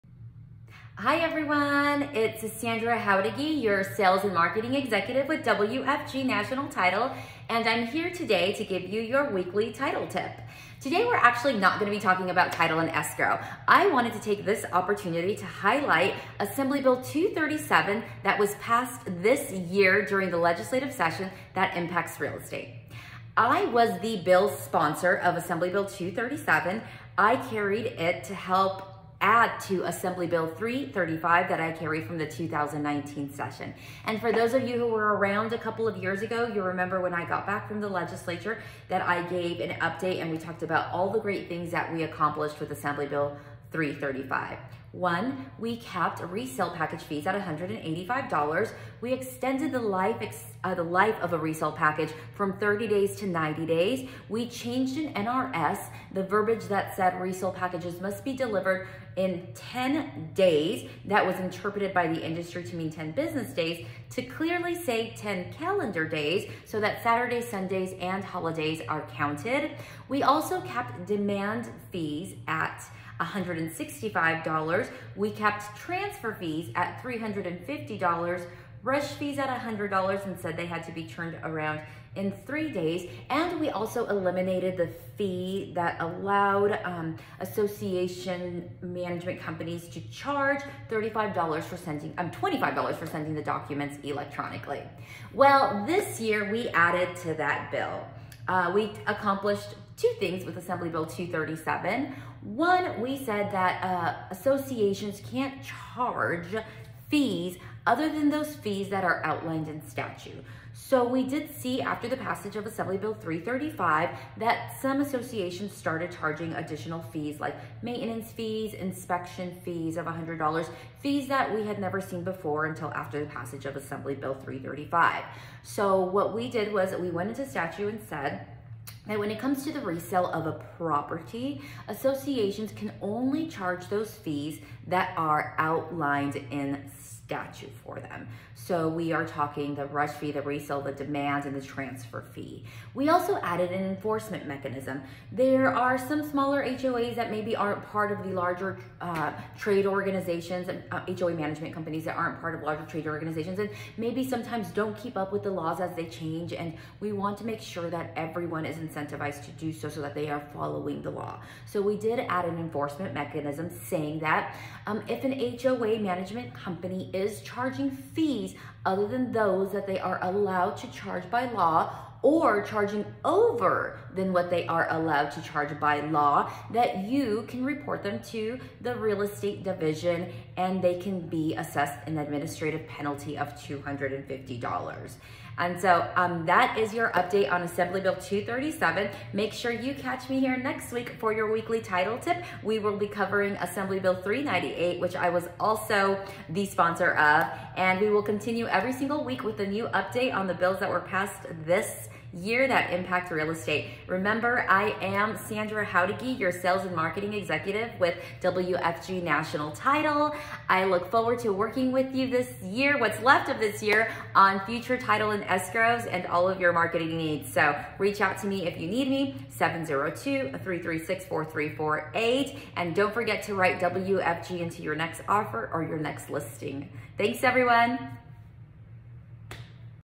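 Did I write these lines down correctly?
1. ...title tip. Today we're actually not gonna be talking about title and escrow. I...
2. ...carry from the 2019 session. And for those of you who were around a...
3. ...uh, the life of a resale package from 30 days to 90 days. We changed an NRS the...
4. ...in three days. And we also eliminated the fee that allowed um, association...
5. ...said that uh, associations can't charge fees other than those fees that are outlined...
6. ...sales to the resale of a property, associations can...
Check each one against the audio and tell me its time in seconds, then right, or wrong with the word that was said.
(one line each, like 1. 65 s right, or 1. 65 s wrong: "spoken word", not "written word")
1. 9 s right
2. 31 s right
3. 50 s right
4. 82 s right
5. 103 s right
6. 129 s wrong: "comes", not "sales".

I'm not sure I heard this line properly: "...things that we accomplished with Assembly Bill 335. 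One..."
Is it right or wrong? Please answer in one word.
right.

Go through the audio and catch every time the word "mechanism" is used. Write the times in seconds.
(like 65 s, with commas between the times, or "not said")
144 s, 163 s.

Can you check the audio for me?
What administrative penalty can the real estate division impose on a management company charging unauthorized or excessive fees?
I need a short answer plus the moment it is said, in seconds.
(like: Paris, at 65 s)
$250, at 183 s.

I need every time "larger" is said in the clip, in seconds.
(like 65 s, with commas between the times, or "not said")
148 s, 152 s.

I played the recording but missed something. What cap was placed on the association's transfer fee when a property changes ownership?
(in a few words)
$350.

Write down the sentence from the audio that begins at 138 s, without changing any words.
So we are talking the rush fee, the resale, the demands, and the transfer fee.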